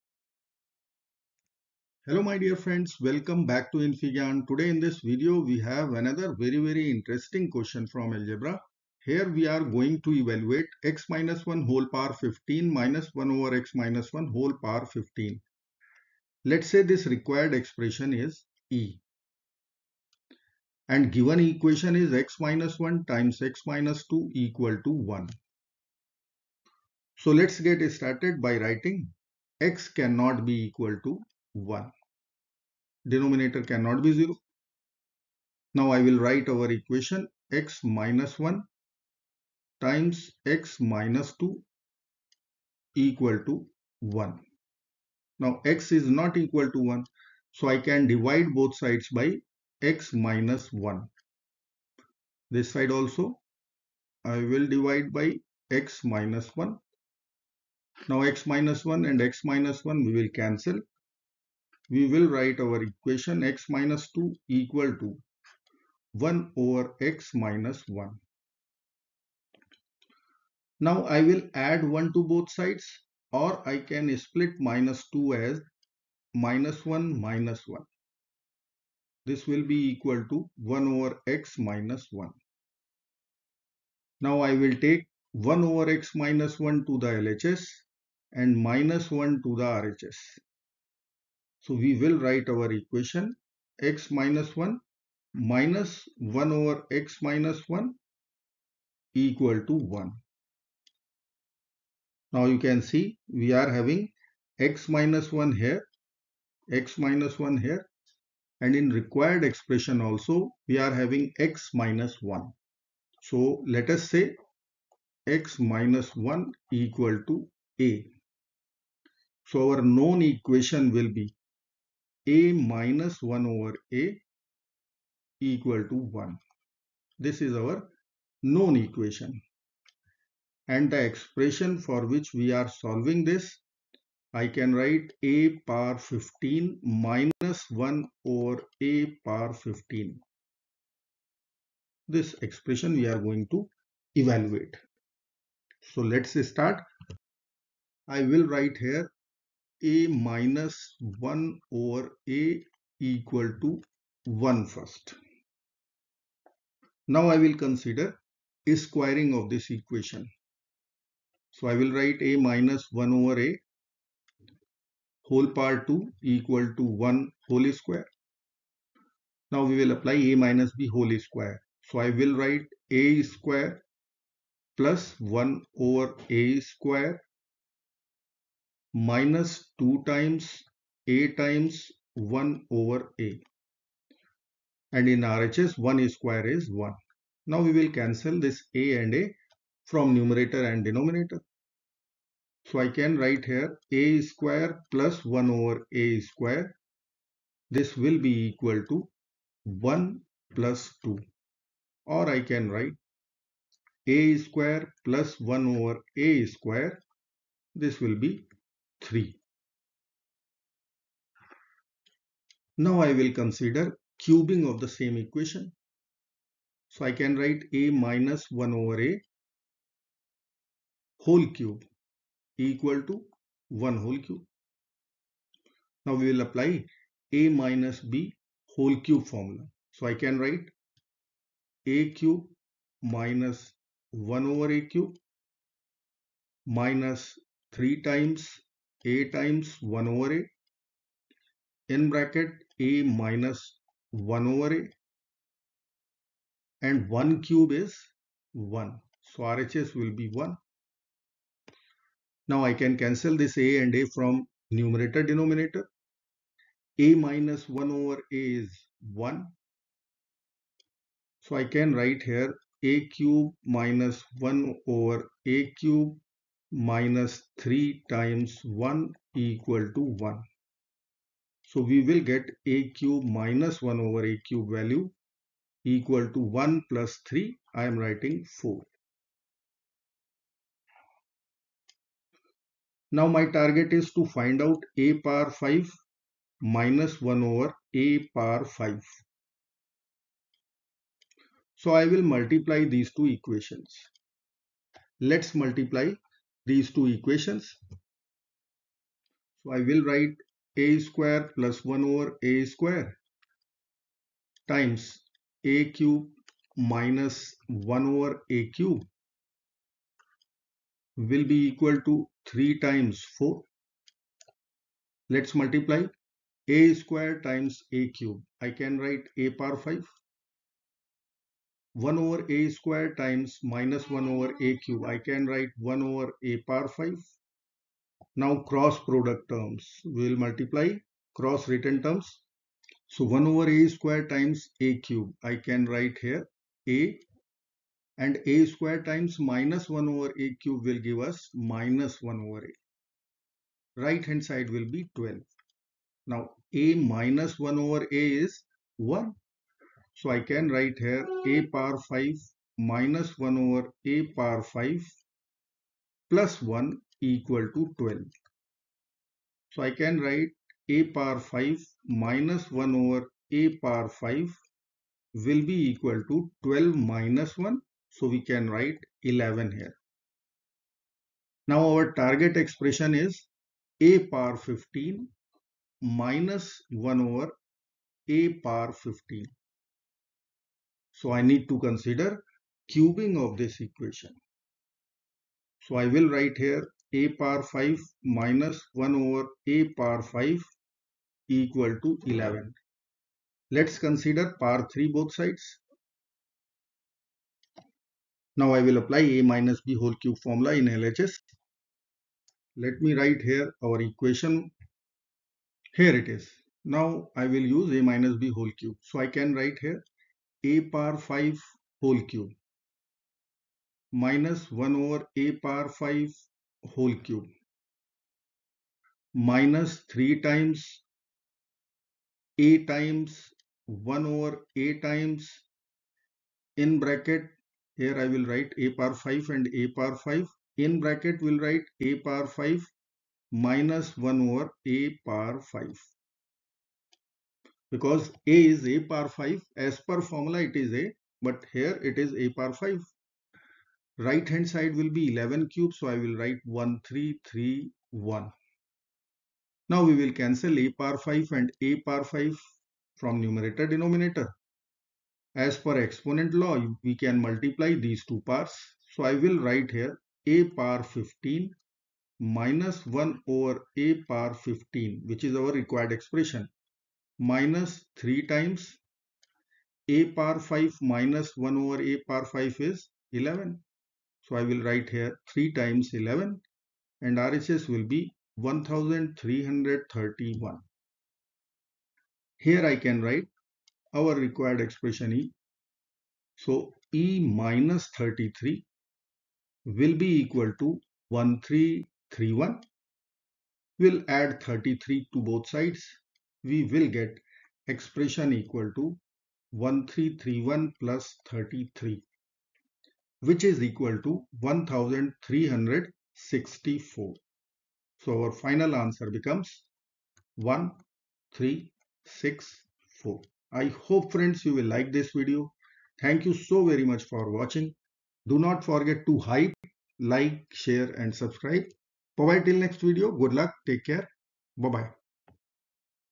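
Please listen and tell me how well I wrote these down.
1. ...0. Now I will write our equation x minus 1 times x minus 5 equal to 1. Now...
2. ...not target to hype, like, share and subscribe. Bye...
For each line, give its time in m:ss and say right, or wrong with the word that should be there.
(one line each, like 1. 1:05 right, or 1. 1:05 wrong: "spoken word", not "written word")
1. 0:34 wrong: "2", not "5"
2. 8:38 wrong: "forget", not "target".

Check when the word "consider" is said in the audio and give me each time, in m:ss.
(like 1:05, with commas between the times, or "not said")
2:37, 3:33, 6:21, 6:33.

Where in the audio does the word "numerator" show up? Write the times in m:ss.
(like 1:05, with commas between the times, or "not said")
3:10, 4:14, 7:33.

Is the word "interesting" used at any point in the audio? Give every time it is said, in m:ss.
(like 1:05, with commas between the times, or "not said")
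0:06.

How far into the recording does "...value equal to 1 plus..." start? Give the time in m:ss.
4:34.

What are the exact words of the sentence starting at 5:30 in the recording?
We will multiply cross written terms.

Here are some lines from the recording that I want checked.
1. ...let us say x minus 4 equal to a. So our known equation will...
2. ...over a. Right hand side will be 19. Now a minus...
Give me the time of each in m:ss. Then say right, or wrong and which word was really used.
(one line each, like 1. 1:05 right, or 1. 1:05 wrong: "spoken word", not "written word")
1. 1:53 wrong: "1", not "4"
2. 5:42 wrong: "12", not "19".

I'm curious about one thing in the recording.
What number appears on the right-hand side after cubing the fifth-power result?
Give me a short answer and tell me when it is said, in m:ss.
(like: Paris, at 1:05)
1331, at 7:26.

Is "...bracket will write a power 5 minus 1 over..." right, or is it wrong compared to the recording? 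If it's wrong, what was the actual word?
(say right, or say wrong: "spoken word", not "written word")
right.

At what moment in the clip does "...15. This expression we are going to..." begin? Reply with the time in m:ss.
2:19.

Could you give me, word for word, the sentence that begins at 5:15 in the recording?
Let's multiply a square times a cube.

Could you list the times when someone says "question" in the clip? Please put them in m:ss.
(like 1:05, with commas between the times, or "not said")
0:07.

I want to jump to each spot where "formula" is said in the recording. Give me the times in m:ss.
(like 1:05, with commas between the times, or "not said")
3:49, 6:40, 7:20.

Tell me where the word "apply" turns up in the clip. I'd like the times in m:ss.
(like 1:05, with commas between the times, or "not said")
2:49, 3:46, 6:38.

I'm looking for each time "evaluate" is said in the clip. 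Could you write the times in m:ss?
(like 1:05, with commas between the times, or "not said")
0:10, 2:24.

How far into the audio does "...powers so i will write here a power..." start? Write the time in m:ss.
7:38.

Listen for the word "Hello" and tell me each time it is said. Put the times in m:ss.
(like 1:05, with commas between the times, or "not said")
0:02.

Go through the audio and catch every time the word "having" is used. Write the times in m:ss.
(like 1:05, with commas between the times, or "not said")
1:43, 1:50.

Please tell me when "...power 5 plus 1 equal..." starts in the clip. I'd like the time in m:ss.
5:54.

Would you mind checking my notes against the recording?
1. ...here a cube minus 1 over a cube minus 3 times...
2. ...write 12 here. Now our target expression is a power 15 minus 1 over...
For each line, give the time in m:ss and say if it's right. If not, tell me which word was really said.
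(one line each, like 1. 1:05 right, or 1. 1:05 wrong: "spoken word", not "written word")
1. 4:22 right
2. 6:08 wrong: "11", not "12".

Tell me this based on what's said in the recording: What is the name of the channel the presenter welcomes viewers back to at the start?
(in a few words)
infyGyan.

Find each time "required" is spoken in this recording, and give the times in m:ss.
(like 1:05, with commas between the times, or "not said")
0:17, 1:48, 7:45, 8:04.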